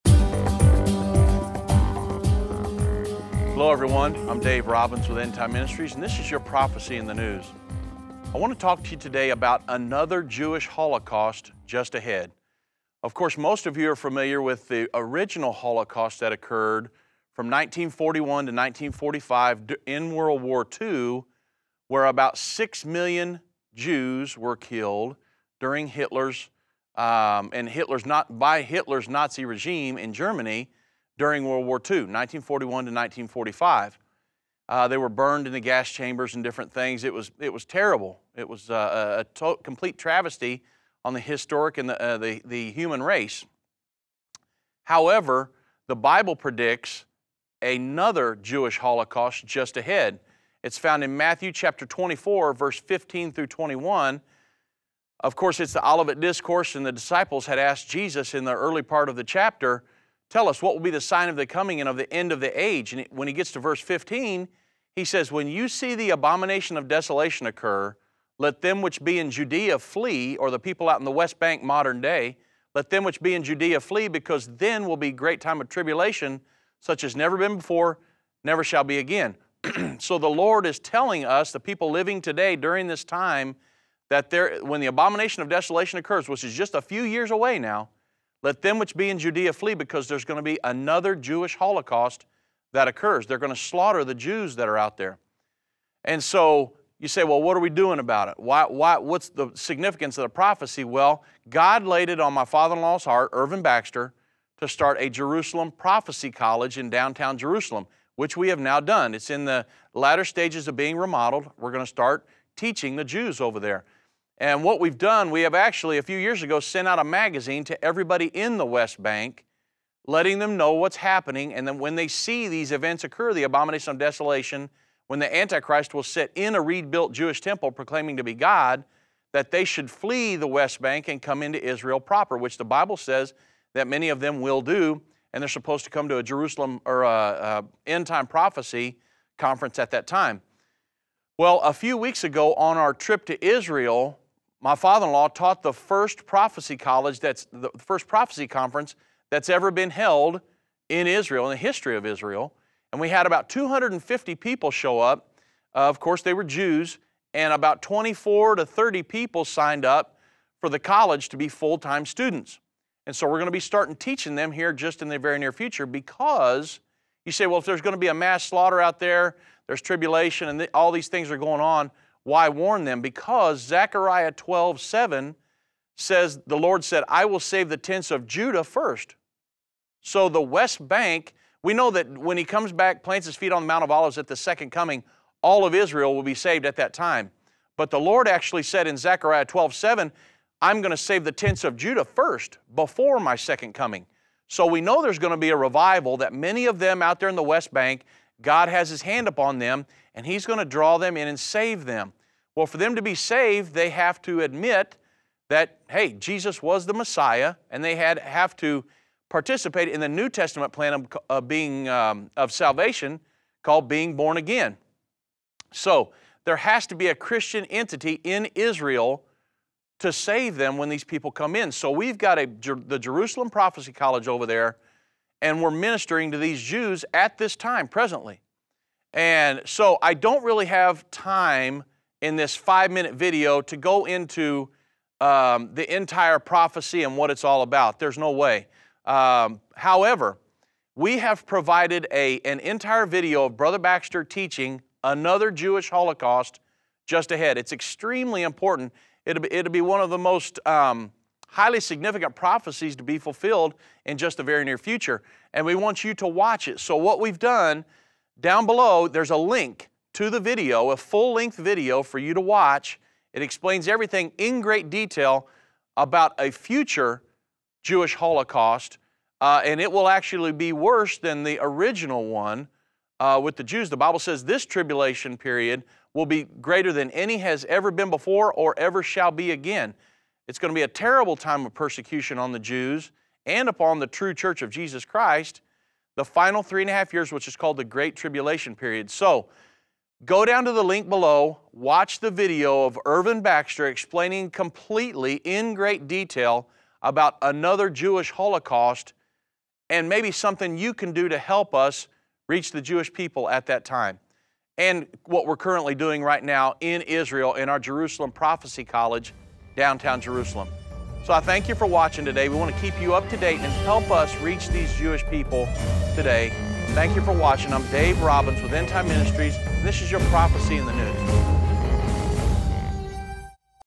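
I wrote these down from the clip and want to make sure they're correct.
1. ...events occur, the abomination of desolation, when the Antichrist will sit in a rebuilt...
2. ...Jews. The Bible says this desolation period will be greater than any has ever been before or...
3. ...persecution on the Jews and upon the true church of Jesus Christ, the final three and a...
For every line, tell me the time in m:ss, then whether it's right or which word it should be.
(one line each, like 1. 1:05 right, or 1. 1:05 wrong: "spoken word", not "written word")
1. 2:02 right
2. 4:33 wrong: "tribulation", not "desolation"
3. 4:41 right.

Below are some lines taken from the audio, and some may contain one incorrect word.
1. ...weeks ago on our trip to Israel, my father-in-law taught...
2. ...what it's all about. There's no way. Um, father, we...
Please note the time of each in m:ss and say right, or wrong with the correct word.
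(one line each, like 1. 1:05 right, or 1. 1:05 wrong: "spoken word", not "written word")
1. 2:21 right
2. 3:57 wrong: "however", not "father".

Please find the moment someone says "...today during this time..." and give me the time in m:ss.
1:22.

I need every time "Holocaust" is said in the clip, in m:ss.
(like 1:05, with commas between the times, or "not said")
0:10, 0:15, 0:48, 1:31, 4:05, 4:28, 4:58.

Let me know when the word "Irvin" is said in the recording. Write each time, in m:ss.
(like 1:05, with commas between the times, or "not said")
1:43, 4:53.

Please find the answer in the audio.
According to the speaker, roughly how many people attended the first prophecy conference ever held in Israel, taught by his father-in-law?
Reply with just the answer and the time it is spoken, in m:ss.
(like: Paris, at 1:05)
250, at 2:33.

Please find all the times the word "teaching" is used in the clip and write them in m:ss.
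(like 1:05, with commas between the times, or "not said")
1:52, 2:43, 4:04.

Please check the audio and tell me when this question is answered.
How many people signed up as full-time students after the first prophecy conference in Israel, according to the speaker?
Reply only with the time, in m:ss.
2:37.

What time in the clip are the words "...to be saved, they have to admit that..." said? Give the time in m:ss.
3:22.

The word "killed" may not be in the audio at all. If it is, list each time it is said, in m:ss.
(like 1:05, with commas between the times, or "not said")
0:24.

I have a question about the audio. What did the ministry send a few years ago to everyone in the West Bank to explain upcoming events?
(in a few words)
a magazine.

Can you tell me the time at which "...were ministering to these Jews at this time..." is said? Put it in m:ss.
3:45.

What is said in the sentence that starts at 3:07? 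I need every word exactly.
But the Lord actually said in Zechariah 12, 7, I'm going to save the tents of Judah first before my second coming.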